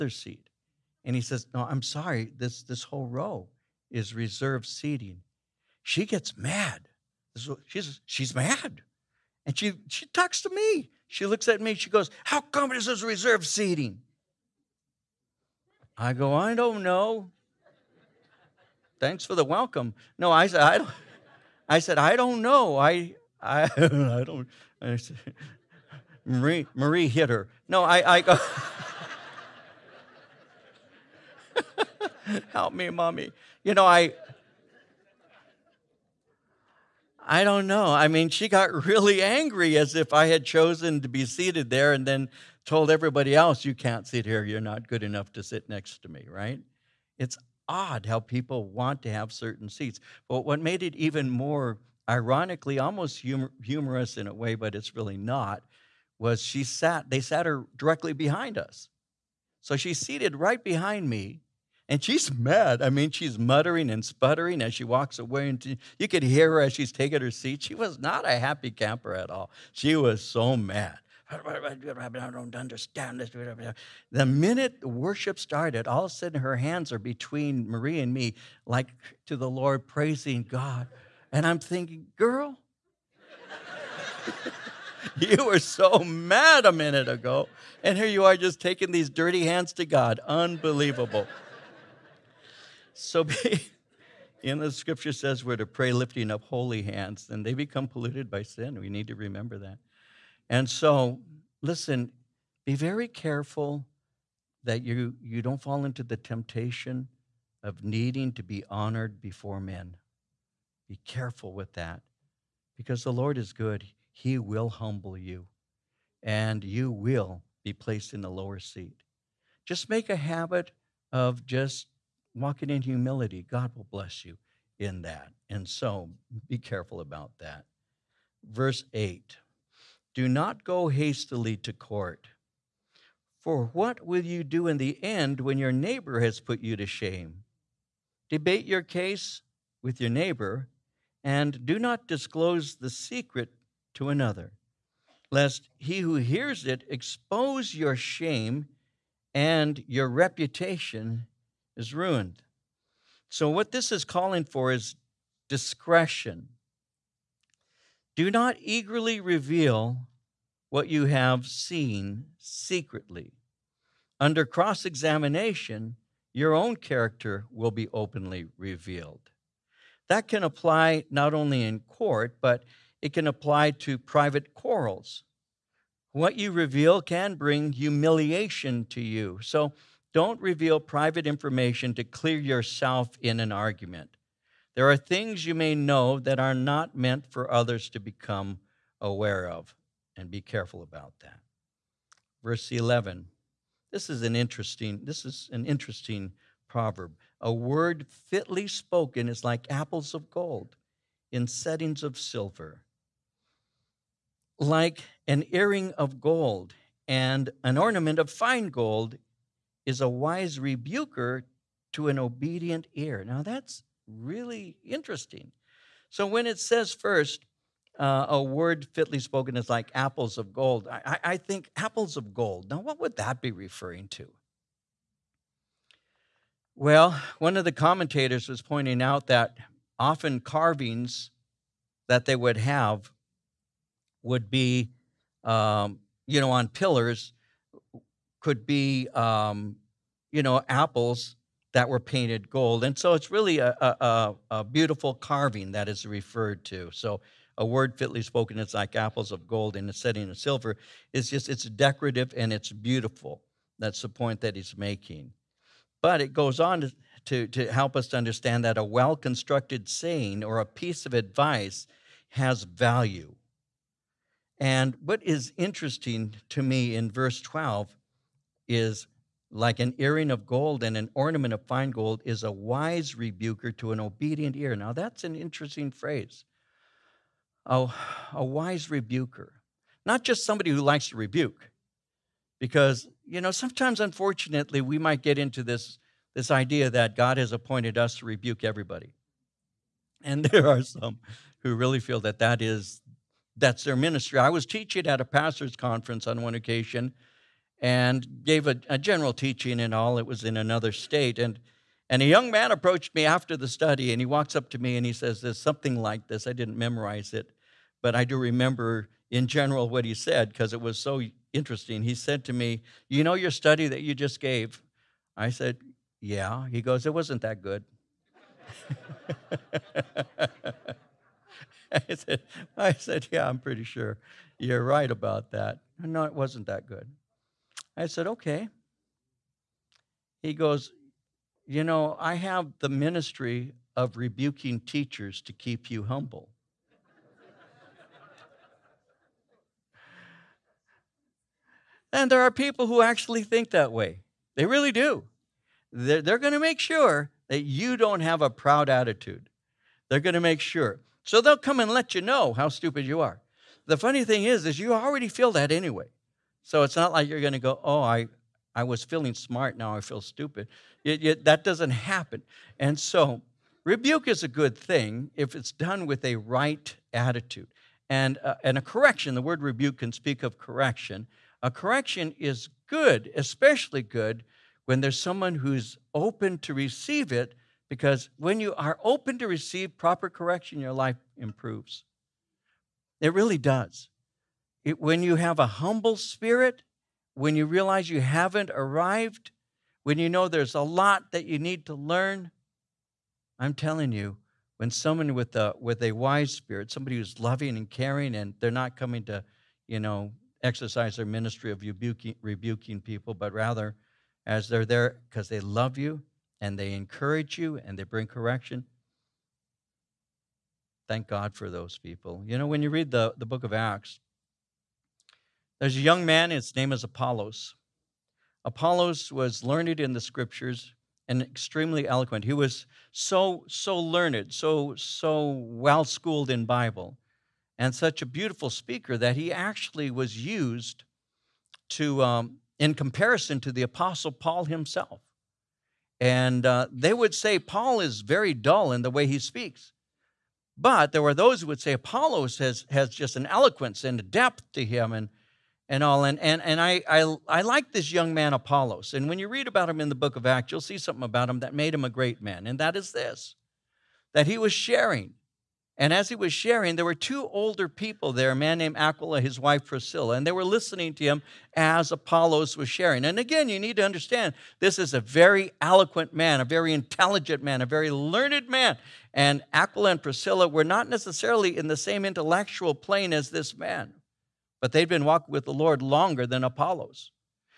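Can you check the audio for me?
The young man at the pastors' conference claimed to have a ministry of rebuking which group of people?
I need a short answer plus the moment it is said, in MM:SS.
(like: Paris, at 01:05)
Teachers, at 05:34.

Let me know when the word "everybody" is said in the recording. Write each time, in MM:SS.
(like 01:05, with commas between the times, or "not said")
00:42, 04:48.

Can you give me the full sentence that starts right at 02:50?
That can apply not only in court, but it can apply to private quarrels.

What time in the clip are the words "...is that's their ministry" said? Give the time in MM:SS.
04:52.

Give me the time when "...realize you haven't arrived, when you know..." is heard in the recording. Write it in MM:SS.
06:27.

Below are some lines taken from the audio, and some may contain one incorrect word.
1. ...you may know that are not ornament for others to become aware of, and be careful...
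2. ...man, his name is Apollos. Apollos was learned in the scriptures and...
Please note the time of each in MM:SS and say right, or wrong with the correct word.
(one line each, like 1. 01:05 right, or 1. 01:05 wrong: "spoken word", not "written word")
1. 03:05 wrong: "meant", not "ornament"
2. 06:56 right.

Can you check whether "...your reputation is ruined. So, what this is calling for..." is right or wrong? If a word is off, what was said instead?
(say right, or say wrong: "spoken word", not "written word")
right.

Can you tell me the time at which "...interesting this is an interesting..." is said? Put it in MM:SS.
03:14.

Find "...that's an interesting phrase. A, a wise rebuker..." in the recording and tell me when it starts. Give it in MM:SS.
04:34.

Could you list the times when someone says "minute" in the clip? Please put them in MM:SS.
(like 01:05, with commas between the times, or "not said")
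01:14, 01:26.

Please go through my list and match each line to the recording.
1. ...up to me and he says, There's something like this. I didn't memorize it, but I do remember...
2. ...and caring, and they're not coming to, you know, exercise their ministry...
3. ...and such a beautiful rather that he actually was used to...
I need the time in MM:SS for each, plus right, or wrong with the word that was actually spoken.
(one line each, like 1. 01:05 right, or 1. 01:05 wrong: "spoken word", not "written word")
1. 05:04 right
2. 06:37 right
3. 07:07 wrong: "speaker", not "rather".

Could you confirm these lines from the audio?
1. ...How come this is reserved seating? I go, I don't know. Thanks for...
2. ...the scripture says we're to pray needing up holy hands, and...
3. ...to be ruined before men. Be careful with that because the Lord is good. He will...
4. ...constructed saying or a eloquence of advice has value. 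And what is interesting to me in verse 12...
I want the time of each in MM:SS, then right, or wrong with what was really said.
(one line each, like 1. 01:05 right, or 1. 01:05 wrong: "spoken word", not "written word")
1. 00:12 right
2. 01:34 wrong: "lifting", not "needing"
3. 01:48 wrong: "honored", not "ruined"
4. 04:19 wrong: "piece", not "eloquence".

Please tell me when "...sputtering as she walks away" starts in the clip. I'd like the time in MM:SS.
01:04.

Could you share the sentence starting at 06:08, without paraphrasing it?
And, uh, and a correction, the word rebuke can speak of correction.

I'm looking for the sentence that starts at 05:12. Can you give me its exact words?
He said to me, You know your study that you just gave?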